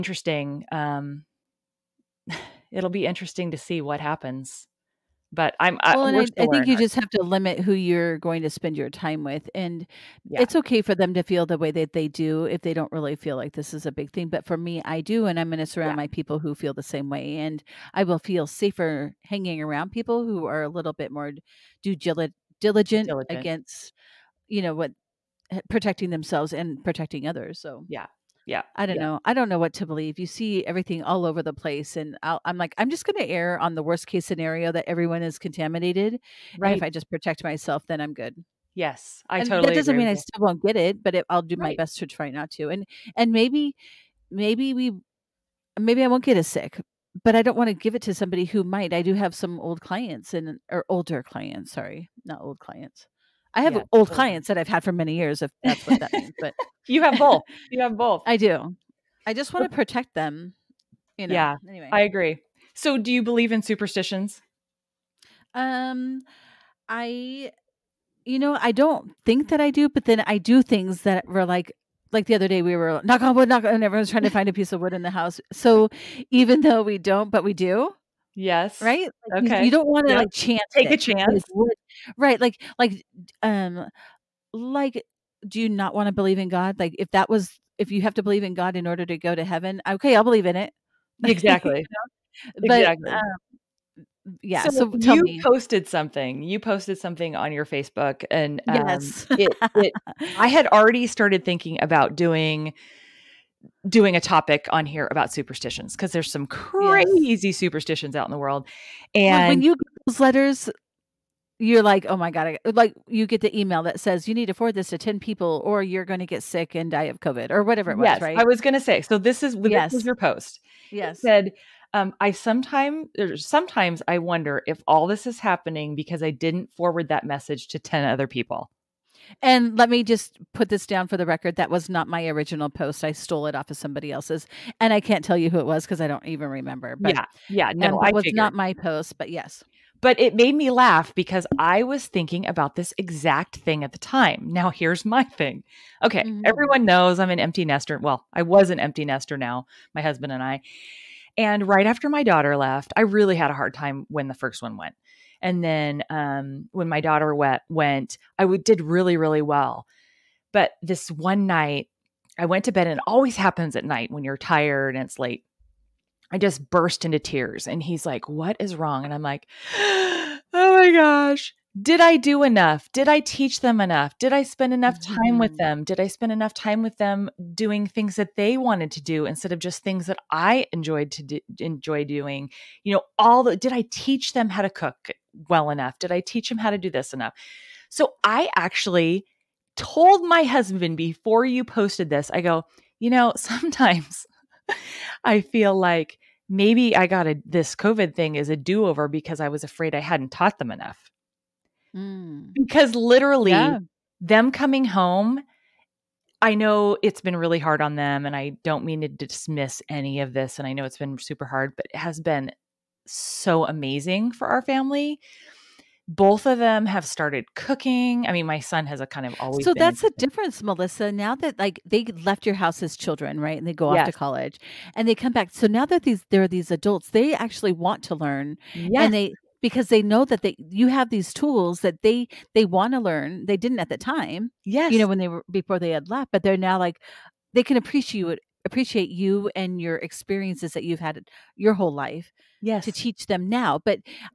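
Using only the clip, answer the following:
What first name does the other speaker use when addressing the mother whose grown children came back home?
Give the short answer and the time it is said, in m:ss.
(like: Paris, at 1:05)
Melissa, at 3:40.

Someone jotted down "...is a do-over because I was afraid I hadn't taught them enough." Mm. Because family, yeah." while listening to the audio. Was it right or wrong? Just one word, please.
wrong.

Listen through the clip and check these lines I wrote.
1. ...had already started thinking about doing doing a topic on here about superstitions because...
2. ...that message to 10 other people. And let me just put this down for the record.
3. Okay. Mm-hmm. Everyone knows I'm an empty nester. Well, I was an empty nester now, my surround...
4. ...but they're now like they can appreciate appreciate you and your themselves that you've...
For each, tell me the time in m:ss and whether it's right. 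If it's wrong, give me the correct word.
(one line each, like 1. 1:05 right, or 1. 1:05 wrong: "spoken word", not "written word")
1. 1:40 right
2. 2:07 right
3. 2:26 wrong: "husband", not "surround"
4. 3:56 wrong: "experiences", not "themselves".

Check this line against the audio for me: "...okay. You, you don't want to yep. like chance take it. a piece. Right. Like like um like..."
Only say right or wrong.
wrong.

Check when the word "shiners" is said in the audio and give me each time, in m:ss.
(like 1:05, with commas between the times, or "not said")
not said.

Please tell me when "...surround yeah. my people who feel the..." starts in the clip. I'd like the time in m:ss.
0:15.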